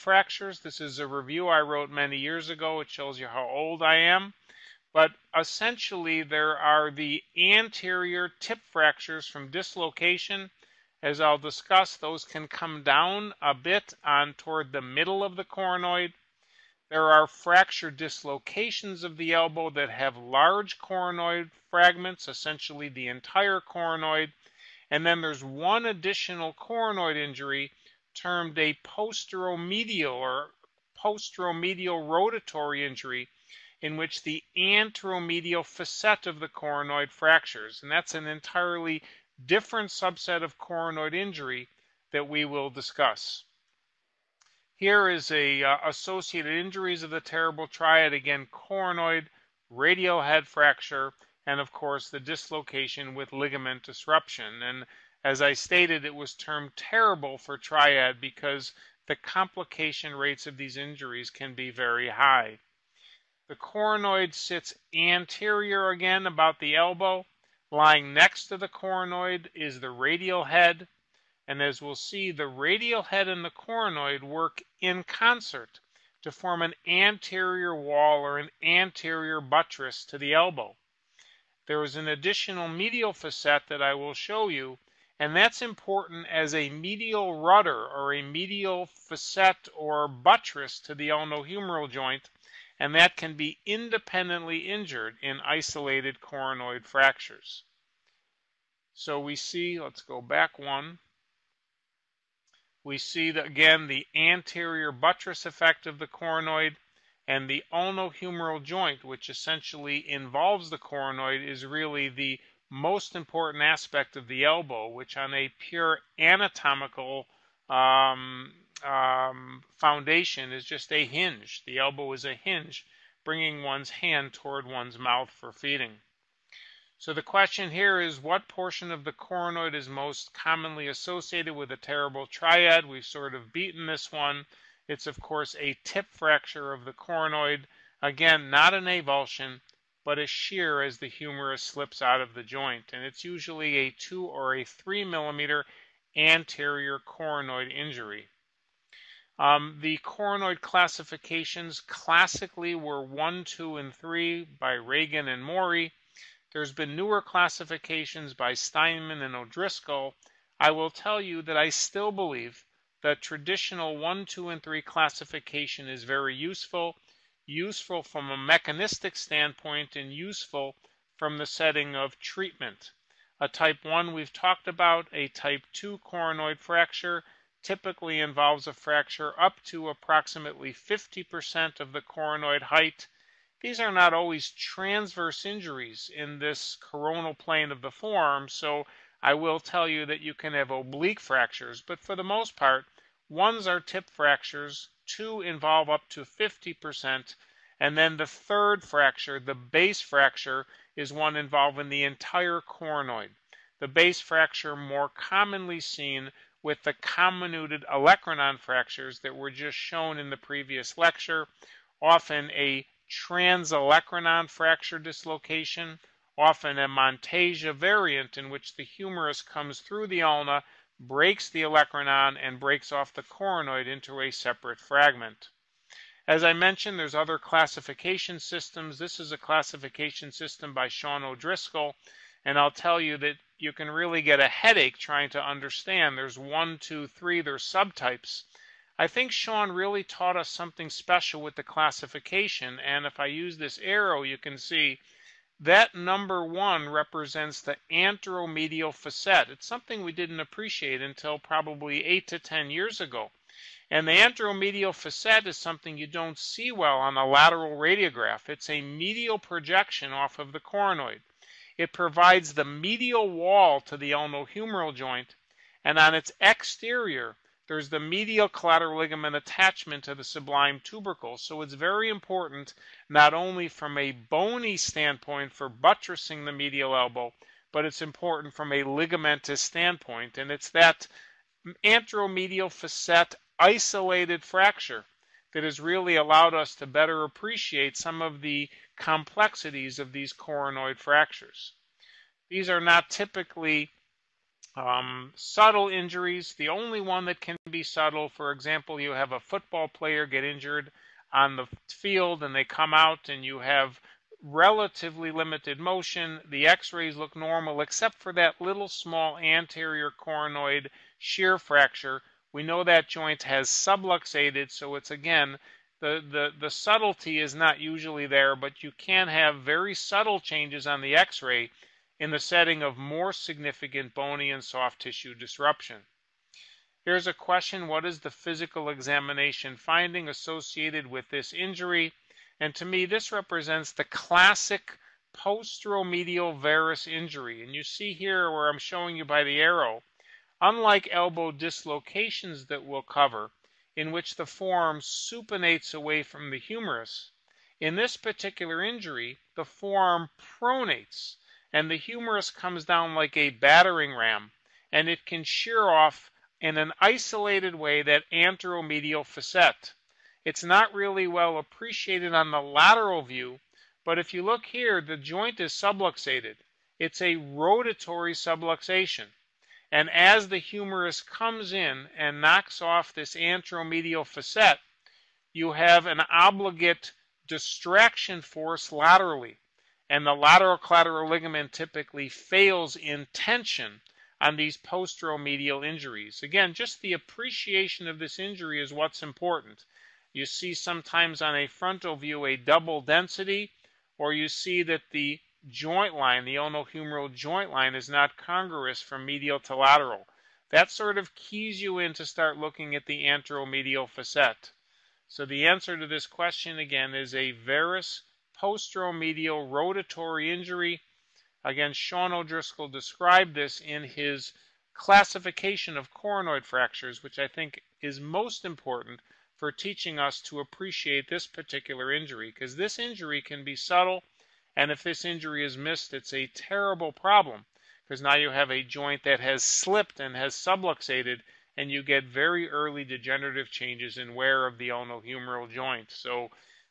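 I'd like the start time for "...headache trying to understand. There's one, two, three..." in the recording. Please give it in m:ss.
3:54.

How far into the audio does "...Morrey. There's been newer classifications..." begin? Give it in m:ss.
2:35.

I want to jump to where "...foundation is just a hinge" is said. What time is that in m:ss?
1:59.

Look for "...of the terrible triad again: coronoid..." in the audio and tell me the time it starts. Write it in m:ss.
0:47.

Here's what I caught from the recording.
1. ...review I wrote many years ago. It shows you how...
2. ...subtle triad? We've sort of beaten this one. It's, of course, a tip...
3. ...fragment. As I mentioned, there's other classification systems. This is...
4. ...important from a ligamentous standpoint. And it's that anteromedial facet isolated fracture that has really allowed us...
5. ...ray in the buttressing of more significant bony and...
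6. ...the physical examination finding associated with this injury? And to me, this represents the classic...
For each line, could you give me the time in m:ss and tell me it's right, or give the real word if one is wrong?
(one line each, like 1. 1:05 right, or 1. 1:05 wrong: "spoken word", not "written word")
1. 0:01 right
2. 2:11 wrong: "terrible", not "subtle"
3. 3:44 right
4. 4:38 right
5. 5:21 wrong: "setting", not "buttressing"
6. 5:28 right.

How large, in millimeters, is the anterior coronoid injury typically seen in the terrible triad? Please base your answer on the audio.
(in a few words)
2 or 3 millimeters.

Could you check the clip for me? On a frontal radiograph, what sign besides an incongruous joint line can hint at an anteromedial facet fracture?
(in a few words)
double density.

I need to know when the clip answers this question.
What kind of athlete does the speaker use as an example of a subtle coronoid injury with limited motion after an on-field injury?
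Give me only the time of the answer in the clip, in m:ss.
4:59.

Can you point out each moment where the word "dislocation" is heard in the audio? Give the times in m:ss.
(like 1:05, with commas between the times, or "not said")
0:09, 0:17, 0:52, 3:34, 5:41.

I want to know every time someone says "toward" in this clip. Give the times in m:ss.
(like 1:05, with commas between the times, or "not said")
0:14, 2:04.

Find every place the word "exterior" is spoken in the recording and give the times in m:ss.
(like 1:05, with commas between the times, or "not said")
4:26.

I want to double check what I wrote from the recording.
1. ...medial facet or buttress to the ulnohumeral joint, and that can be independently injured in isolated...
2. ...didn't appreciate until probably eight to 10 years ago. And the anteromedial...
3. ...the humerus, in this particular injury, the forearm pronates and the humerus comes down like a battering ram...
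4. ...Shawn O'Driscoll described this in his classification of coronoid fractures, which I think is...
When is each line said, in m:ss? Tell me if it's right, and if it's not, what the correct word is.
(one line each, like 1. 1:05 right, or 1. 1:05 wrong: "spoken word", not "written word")
1. 1:28 right
2. 4:10 right
3. 5:46 right
4. 6:51 right.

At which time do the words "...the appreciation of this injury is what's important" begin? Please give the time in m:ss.
6:27.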